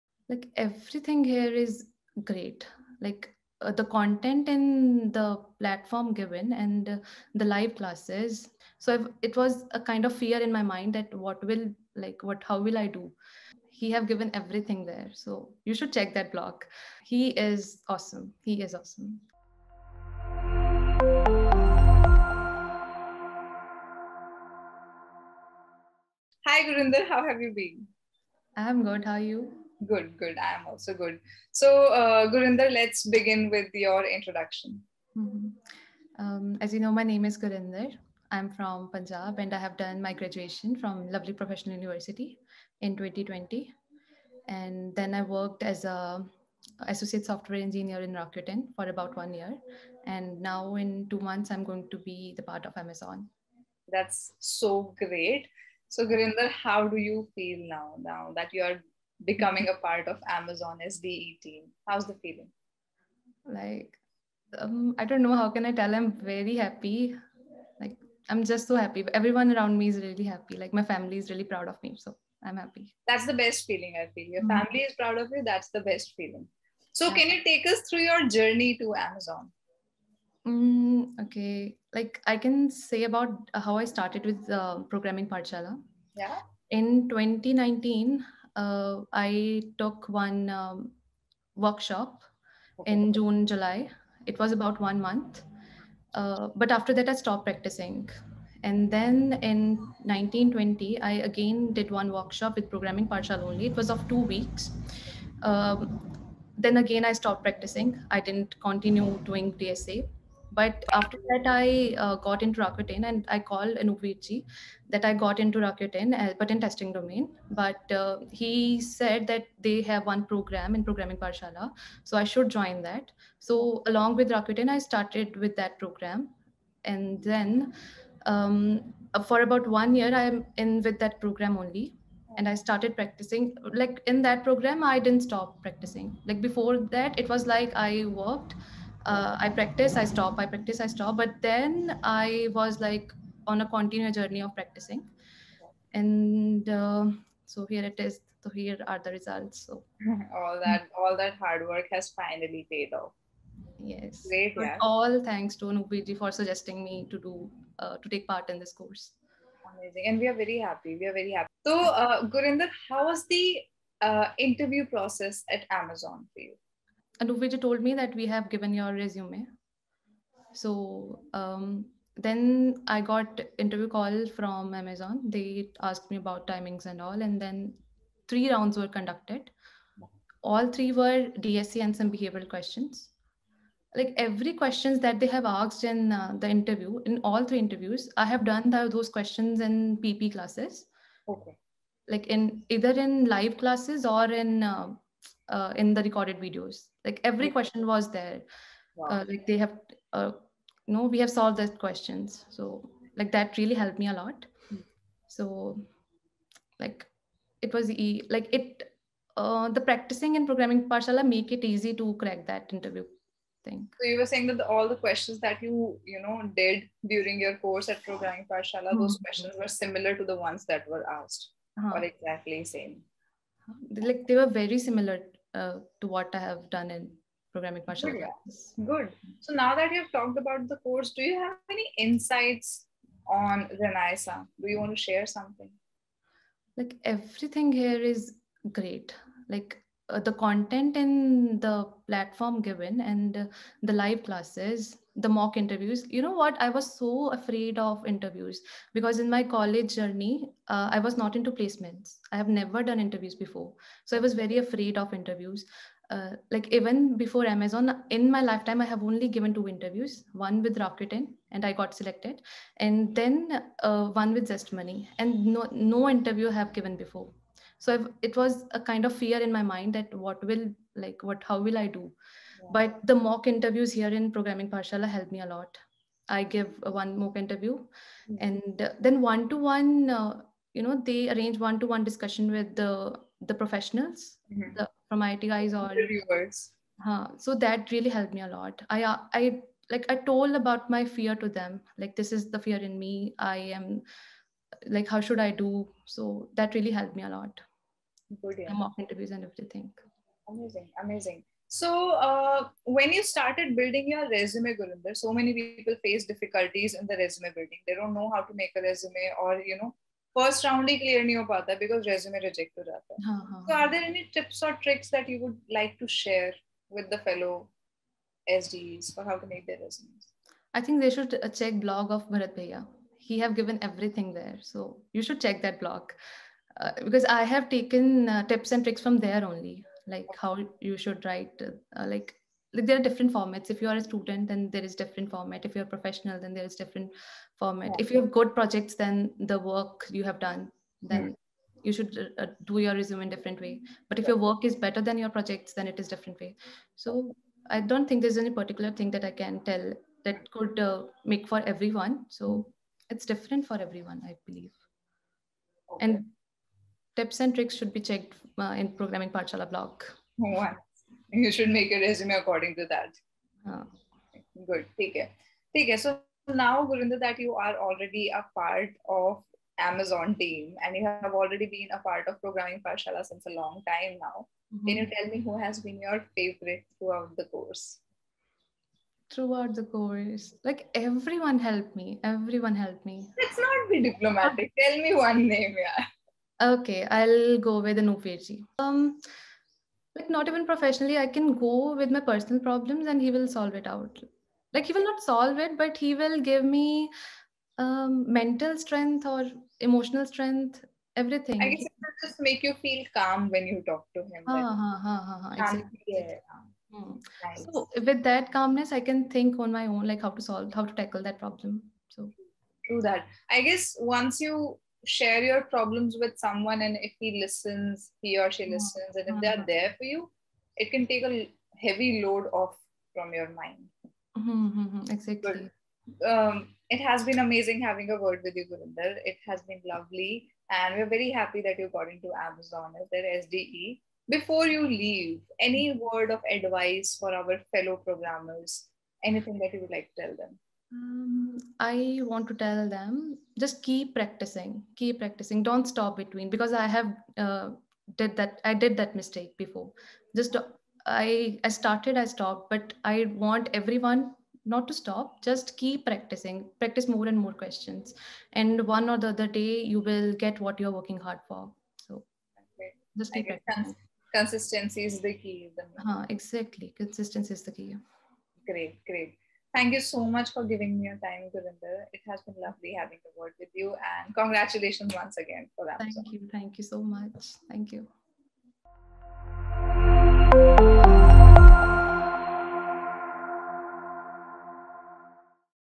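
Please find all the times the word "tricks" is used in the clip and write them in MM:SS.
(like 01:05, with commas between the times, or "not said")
05:14, 05:28, 05:57.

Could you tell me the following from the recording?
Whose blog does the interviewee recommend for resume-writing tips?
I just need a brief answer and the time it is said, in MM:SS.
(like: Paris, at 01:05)
Bharat Bhaiya, at 05:22.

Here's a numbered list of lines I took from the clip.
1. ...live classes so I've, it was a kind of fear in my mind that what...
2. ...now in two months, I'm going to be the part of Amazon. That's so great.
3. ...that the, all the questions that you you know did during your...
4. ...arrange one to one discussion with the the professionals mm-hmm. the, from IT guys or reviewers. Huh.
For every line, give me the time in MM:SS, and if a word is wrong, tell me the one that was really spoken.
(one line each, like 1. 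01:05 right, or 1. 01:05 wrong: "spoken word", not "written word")
1. 00:07 right
2. 00:50 right
3. 03:34 right
4. 04:41 right.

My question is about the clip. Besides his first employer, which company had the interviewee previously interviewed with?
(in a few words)
Zest Money.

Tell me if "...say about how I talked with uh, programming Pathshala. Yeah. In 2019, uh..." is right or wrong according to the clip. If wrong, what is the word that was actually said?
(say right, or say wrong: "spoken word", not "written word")
wrong: "started", not "talked".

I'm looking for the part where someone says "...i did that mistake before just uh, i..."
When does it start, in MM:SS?
07:28.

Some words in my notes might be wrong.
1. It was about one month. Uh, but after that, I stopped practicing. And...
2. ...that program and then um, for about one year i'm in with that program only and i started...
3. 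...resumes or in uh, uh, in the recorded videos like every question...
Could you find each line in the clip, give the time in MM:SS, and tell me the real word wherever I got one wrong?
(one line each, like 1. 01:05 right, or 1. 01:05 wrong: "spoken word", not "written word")
1. 01:34 right
2. 02:05 right
3. 03:13 wrong: "classes", not "resumes".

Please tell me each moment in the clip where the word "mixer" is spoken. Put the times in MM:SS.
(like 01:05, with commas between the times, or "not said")
not said.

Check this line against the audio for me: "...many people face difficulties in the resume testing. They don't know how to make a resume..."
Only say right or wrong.
wrong.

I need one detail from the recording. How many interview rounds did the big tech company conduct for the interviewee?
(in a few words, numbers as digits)
3.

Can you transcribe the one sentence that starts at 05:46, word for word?
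So I don't think there's any particular thing that I can tell that could uh, make for everyone.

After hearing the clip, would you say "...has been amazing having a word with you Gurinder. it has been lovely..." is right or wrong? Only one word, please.
right.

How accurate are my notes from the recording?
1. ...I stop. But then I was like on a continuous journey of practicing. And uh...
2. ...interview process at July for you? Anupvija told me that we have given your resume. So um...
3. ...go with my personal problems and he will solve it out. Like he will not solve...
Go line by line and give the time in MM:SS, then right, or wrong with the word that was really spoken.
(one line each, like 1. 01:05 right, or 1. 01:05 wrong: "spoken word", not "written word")
1. 02:20 right
2. 02:44 wrong: "Amazon", not "July"
3. 06:31 right.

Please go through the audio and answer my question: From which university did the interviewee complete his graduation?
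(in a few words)
Lovely Professional University.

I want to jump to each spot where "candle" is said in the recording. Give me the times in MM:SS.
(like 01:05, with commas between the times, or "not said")
not said.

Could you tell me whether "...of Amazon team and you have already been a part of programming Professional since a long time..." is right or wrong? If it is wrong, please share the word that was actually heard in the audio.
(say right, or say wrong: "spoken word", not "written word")
wrong: "Pathshala", not "Professional".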